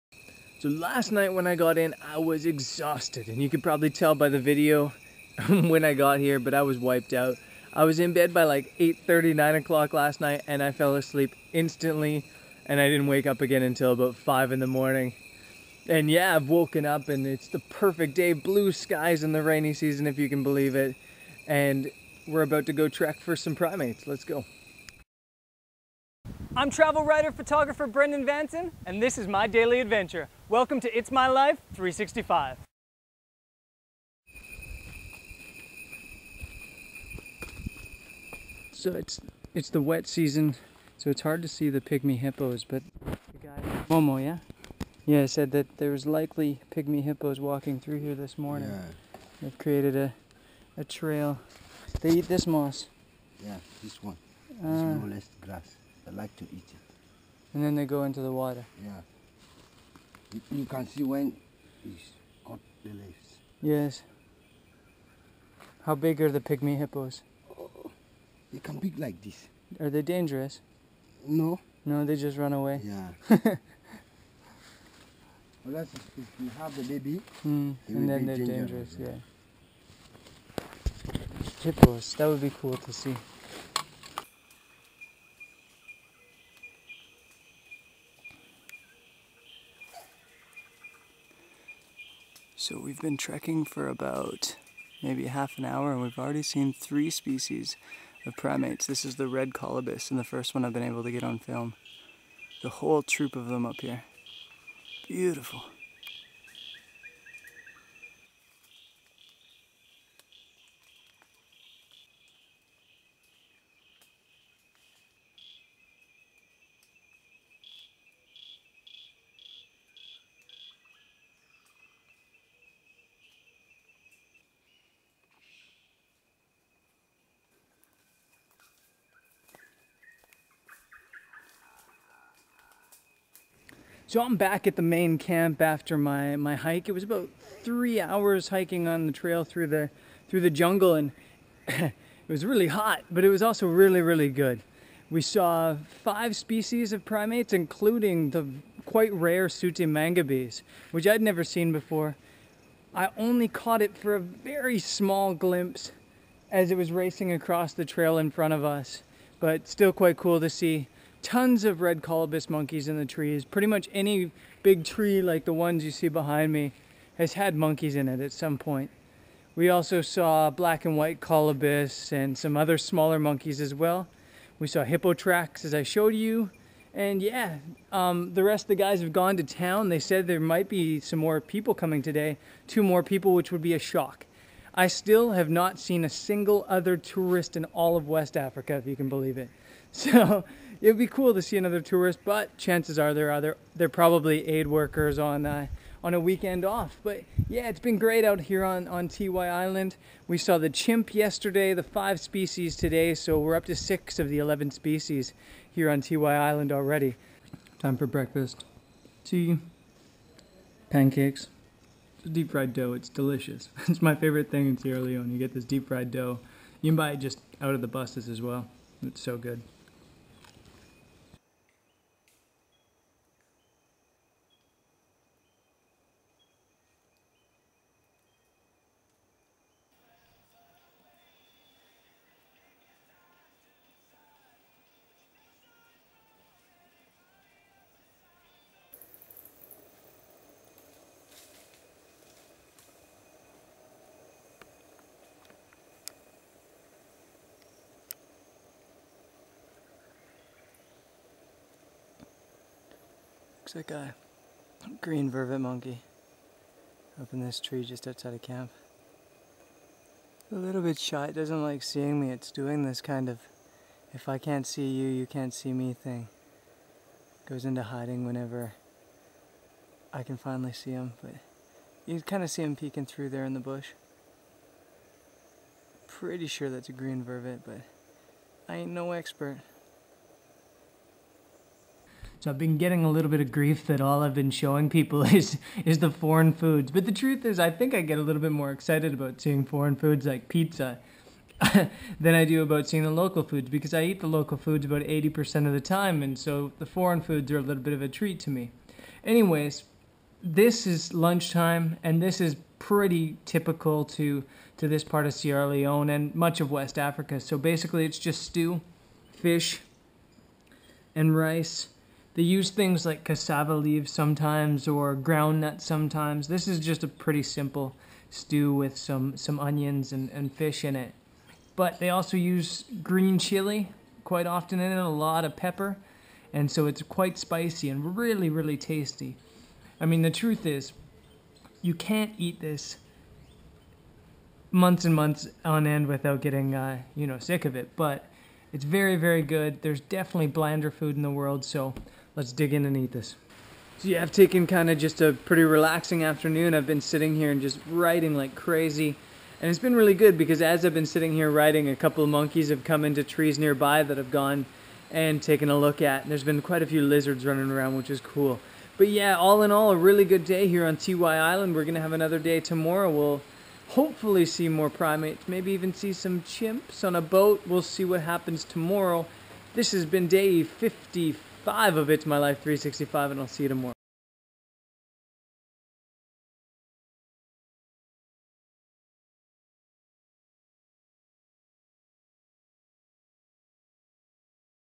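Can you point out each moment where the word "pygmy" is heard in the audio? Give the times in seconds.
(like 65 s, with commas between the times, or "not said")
41 s, 46 s, 66 s.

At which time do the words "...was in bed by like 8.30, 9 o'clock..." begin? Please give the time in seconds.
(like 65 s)
7 s.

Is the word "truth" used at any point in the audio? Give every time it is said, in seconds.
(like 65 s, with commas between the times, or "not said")
287 s, 330 s.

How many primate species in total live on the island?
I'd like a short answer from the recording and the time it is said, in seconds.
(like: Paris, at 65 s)
11, at 204 s.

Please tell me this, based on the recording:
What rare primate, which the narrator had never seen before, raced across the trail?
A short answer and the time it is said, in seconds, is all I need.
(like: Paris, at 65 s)
sooty mangabeys, at 149 s.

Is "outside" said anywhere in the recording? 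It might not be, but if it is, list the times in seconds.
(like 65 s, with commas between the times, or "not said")
258 s.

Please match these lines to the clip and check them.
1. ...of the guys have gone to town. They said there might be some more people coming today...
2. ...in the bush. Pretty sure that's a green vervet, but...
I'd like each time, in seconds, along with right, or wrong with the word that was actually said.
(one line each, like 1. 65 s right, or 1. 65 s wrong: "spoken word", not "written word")
1. 178 s right
2. 273 s right.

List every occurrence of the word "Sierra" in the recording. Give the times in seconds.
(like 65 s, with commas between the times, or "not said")
214 s, 305 s.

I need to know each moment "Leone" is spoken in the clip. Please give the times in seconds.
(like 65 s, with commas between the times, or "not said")
214 s, 305 s.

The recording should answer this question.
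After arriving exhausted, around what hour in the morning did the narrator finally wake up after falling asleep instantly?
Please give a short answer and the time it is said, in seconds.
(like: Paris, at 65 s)
5, at 13 s.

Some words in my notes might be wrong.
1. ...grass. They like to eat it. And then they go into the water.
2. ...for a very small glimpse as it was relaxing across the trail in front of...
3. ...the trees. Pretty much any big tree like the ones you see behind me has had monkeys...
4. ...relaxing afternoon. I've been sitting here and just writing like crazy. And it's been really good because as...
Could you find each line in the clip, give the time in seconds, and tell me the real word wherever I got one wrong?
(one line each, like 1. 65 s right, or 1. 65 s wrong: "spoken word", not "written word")
1. 55 s right
2. 153 s wrong: "racing", not "relaxing"
3. 162 s right
4. 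345 s right.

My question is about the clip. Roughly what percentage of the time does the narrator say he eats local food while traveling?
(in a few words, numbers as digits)
80%.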